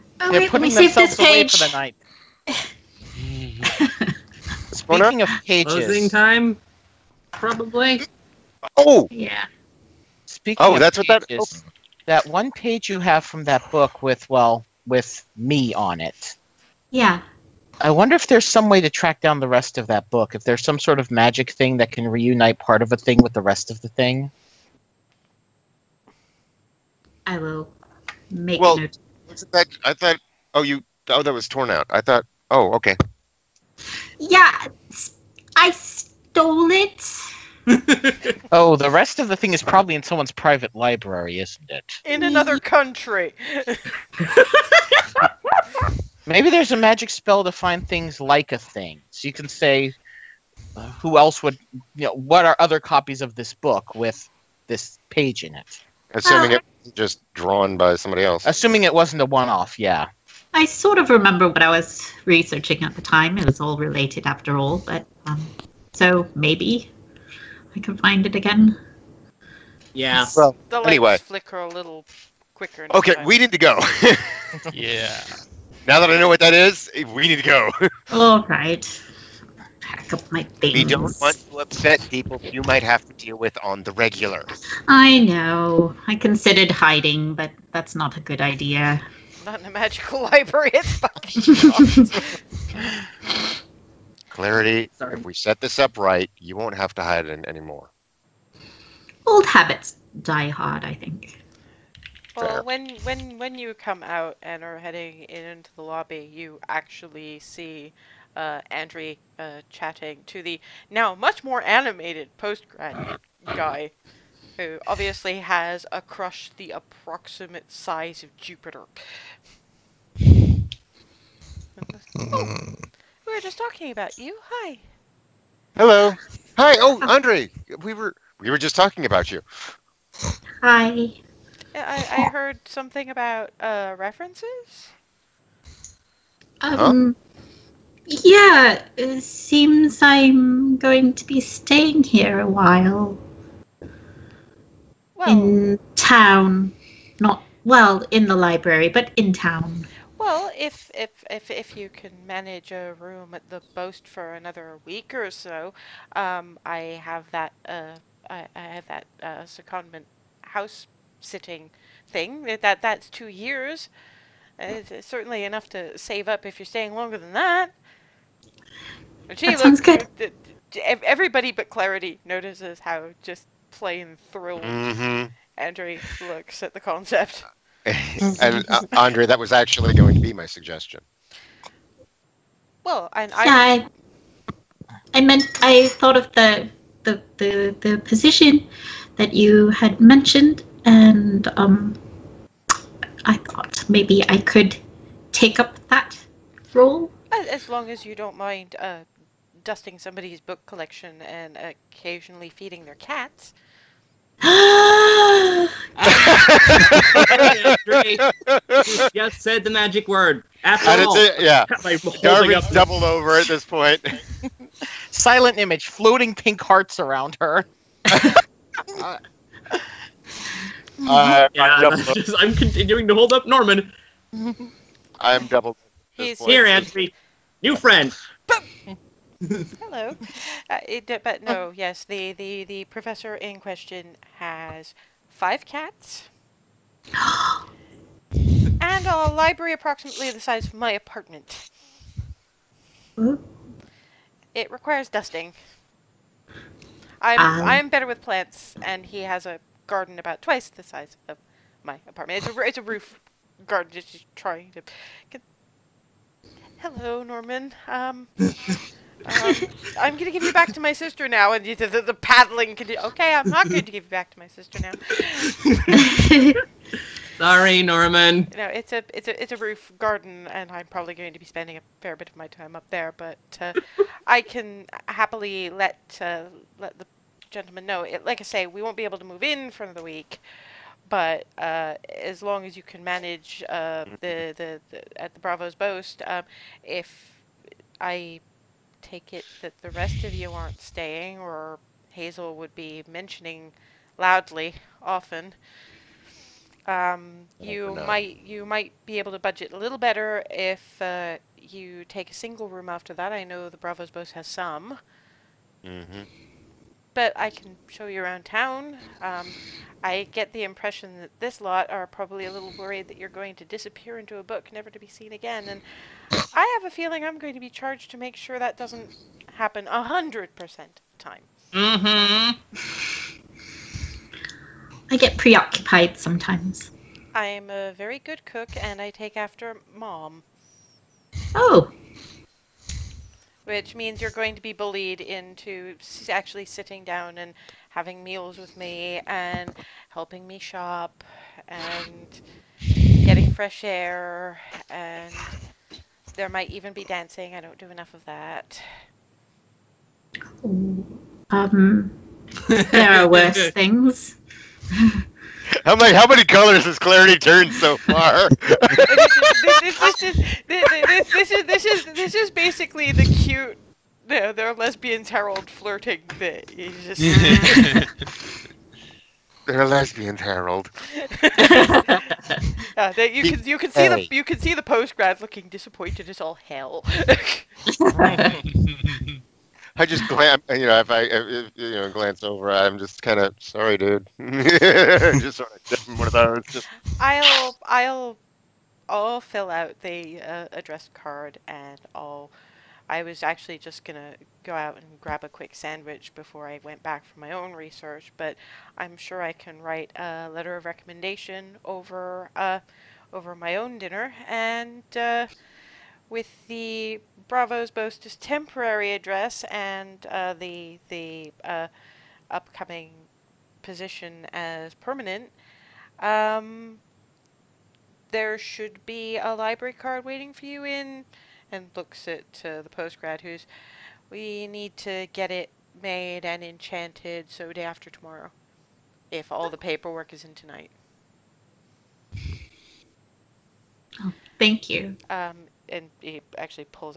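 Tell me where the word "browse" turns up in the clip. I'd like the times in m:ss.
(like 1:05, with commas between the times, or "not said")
not said.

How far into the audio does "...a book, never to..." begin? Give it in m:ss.
5:14.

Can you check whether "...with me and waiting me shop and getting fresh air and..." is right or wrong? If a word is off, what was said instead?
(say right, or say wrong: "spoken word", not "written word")
wrong: "helping", not "waiting".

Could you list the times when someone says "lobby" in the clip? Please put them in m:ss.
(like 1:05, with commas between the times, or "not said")
1:45.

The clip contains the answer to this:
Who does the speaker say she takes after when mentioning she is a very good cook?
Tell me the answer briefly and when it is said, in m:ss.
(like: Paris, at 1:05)
Mom, at 5:29.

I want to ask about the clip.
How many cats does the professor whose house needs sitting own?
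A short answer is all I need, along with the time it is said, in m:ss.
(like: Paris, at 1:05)
5, at 3:55.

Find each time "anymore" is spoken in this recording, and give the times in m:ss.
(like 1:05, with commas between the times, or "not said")
1:37.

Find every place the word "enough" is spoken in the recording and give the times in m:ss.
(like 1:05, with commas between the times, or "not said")
2:45, 5:47.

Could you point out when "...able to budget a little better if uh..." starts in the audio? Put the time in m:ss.
4:59.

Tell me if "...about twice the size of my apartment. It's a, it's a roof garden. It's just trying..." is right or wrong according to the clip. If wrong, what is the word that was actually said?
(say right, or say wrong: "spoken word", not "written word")
right.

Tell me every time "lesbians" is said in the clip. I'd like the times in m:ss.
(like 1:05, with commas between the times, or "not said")
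6:04, 6:09.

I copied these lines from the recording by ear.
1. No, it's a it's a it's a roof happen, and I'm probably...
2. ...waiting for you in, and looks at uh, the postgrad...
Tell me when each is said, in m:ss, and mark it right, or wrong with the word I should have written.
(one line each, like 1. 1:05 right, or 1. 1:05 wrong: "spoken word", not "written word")
1. 4:28 wrong: "garden", not "happen"
2. 7:00 right.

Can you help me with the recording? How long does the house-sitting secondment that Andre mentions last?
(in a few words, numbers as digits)
2 years.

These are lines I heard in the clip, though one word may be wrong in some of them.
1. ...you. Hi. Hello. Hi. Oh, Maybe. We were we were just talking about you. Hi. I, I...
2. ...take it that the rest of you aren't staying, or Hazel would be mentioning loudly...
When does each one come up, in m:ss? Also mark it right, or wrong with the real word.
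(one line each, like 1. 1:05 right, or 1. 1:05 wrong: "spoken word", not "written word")
1. 2:04 wrong: "Andre", not "Maybe"
2. 4:49 right.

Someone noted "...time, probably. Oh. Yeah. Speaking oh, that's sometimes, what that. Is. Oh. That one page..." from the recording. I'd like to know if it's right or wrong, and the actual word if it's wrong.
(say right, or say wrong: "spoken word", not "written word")
wrong: "pages", not "sometimes".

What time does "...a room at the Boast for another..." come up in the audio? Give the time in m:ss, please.
2:32.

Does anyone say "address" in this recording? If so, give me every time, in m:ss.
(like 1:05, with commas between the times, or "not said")
6:30, 6:49.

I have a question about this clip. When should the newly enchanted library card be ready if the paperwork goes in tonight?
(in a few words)
Day after tomorrow.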